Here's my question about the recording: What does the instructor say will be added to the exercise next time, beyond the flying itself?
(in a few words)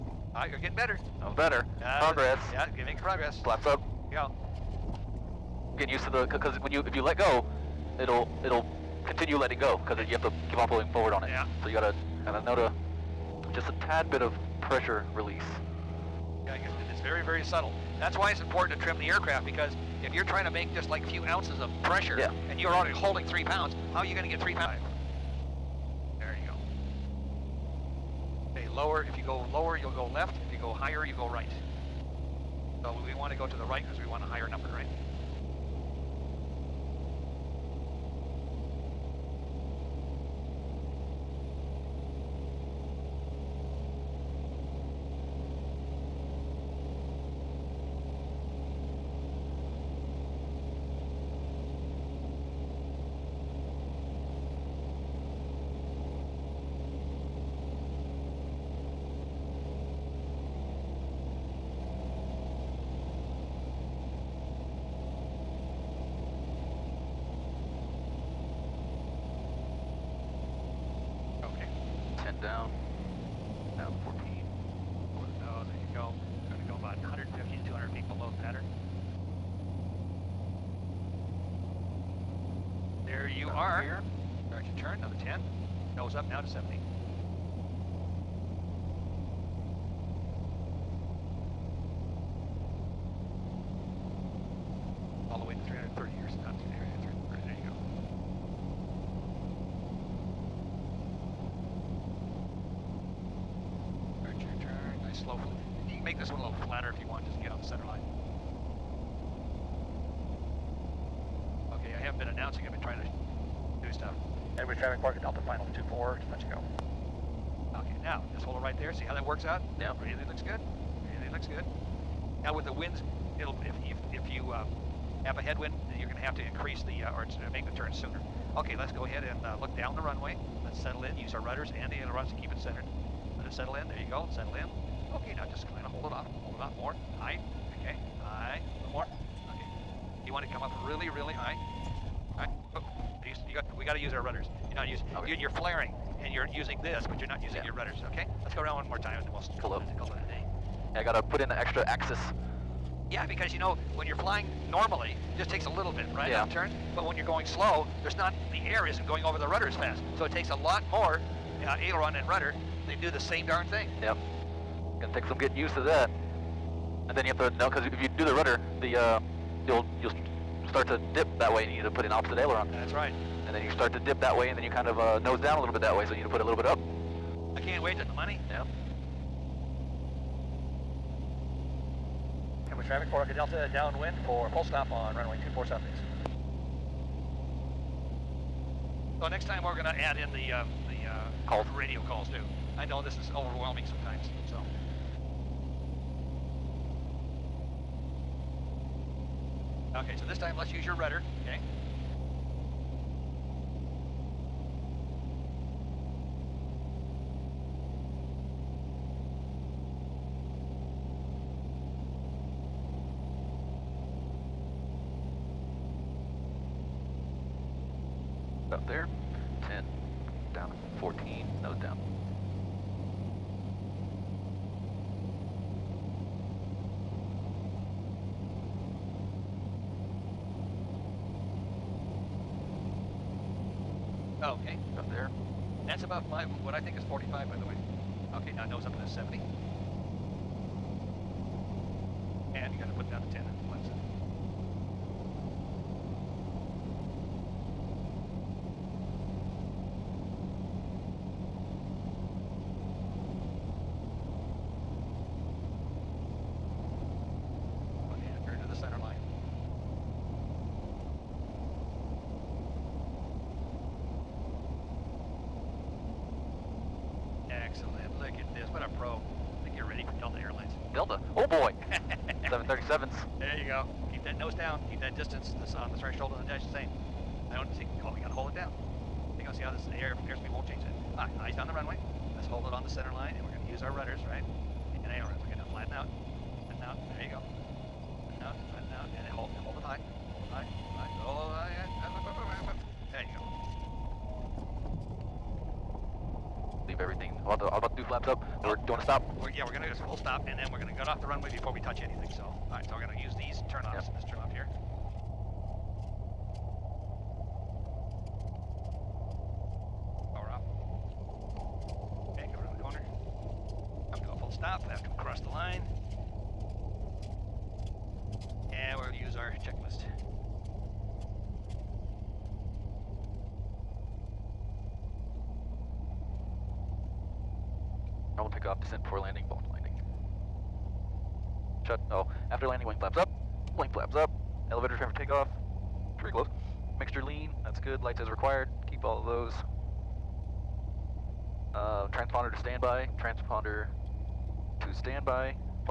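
radio calls.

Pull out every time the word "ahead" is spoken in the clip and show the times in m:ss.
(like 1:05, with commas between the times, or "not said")
2:09.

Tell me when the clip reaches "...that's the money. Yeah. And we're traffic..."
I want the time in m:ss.
2:57.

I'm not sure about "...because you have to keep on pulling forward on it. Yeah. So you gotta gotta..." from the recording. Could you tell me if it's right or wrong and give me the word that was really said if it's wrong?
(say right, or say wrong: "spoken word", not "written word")
right.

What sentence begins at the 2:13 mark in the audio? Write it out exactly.
Let it settle in, there you go, settle in.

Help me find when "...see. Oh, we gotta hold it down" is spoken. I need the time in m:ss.
4:37.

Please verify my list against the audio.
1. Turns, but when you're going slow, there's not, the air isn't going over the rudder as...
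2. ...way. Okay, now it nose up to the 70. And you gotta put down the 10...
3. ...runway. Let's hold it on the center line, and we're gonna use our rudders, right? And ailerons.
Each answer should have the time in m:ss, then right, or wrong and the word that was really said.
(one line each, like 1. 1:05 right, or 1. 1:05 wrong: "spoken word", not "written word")
1. 2:36 right
2. 3:57 right
3. 4:41 right.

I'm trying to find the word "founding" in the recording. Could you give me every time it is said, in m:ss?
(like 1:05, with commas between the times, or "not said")
not said.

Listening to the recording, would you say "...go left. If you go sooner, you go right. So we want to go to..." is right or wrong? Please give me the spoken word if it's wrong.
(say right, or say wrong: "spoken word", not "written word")
wrong: "higher", not "sooner".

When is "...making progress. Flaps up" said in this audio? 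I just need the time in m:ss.
0:02.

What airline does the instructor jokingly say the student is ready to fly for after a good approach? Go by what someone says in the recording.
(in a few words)
Delta Airlines.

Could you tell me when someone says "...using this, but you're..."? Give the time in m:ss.
2:26.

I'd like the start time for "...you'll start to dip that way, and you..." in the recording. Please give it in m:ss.
2:50.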